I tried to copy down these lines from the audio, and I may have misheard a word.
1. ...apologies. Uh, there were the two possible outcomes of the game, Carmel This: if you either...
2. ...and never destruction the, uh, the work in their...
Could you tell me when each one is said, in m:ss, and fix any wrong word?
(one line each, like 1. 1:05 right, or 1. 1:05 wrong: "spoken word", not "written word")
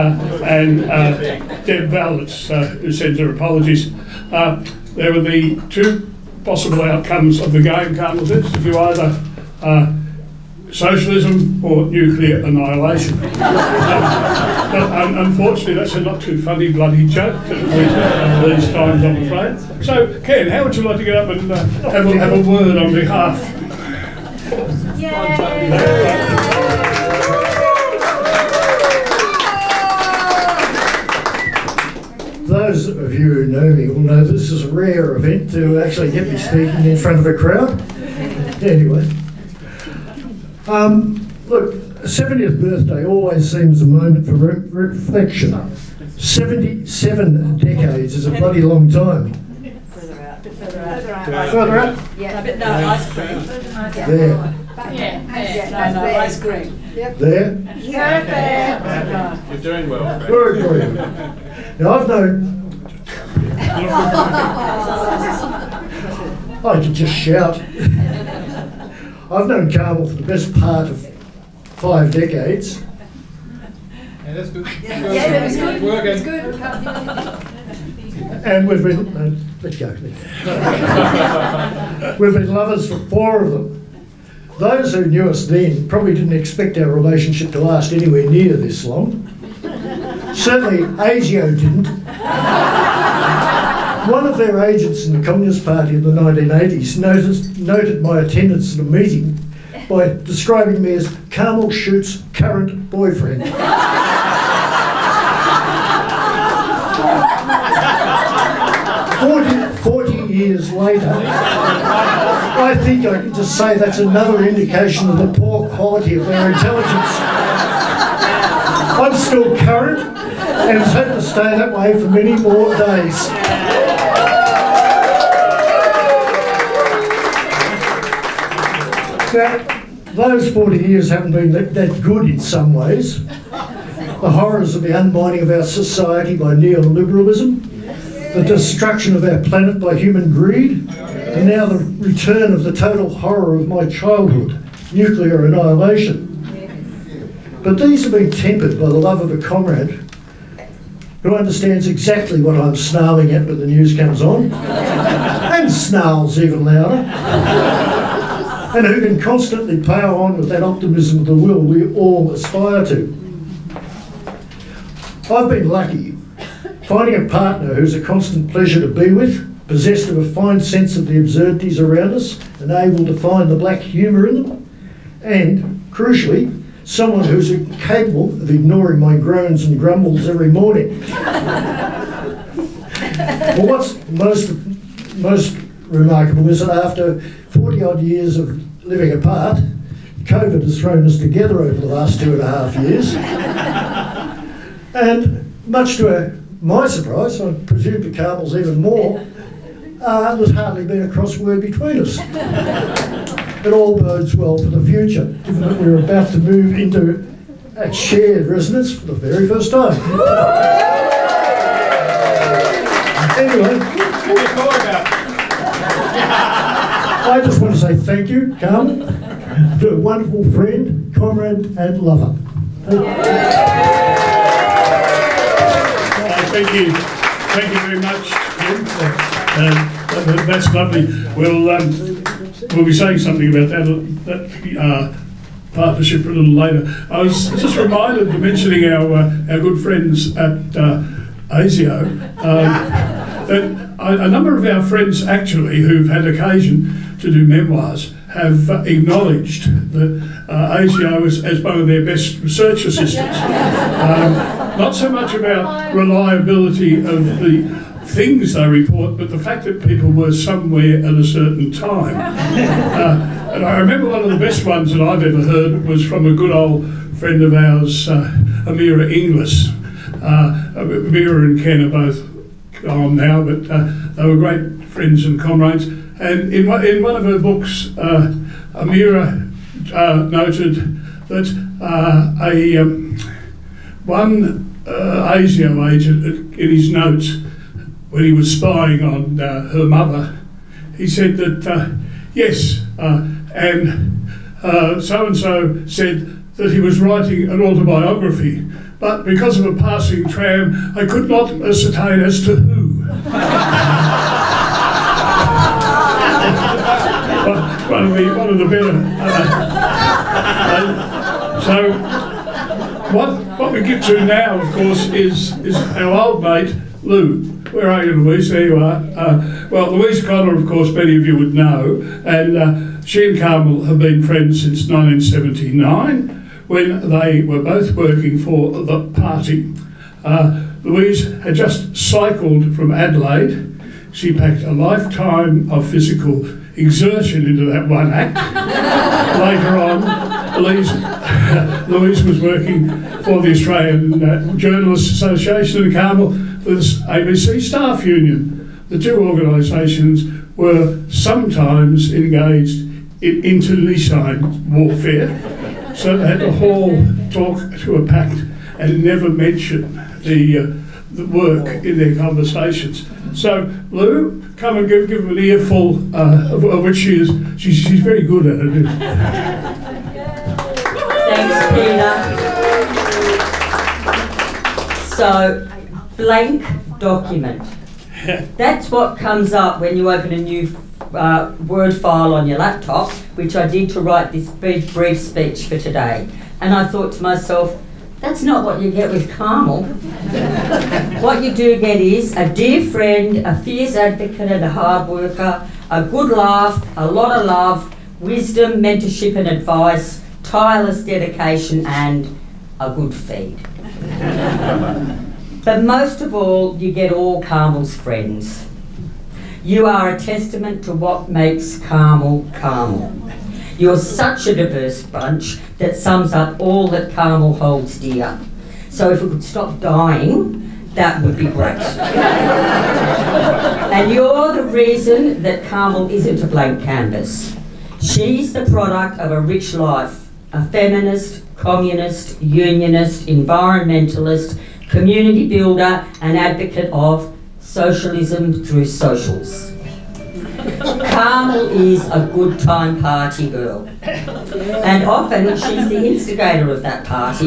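1. 0:03 right
2. 5:58 wrong: "mention", not "destruction".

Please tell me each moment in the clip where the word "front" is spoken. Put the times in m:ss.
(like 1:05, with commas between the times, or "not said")
0:36.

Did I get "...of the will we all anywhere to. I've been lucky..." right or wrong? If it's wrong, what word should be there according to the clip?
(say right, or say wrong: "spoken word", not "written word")
wrong: "aspire", not "anywhere".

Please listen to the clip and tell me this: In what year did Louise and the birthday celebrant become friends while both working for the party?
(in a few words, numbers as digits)
1979.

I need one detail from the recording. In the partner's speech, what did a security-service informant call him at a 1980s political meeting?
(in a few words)
Carmel Shute's current boyfriend.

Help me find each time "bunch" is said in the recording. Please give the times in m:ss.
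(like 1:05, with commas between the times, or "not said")
6:55.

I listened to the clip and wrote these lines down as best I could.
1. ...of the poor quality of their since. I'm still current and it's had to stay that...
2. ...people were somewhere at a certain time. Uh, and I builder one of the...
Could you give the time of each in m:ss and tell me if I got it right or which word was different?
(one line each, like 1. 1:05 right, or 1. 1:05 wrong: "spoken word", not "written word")
1. 1:55 wrong: "intelligence", not "since"
2. 4:19 wrong: "remember", not "builder".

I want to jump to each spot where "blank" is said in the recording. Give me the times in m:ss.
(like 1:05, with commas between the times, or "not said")
6:16, 7:06.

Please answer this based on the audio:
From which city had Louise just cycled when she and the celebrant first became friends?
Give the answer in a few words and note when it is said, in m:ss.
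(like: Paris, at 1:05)
Adelaide, at 5:32.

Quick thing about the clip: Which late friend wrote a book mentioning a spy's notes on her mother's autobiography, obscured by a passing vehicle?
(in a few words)
Amirah Inglis.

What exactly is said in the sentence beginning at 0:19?
So, Ken, how would you like to get up and uh, have, a, have a word on behalf?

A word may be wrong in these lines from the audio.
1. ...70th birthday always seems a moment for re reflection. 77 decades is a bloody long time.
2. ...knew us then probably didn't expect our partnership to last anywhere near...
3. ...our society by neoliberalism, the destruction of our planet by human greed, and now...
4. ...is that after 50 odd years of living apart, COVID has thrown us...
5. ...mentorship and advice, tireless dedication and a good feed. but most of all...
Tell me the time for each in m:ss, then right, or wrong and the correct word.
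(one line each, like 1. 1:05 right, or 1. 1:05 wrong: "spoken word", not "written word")
1. 0:42 right
2. 1:25 wrong: "relationship", not "partnership"
3. 2:15 right
4. 3:06 wrong: "40", not "50"
5. 6:38 right.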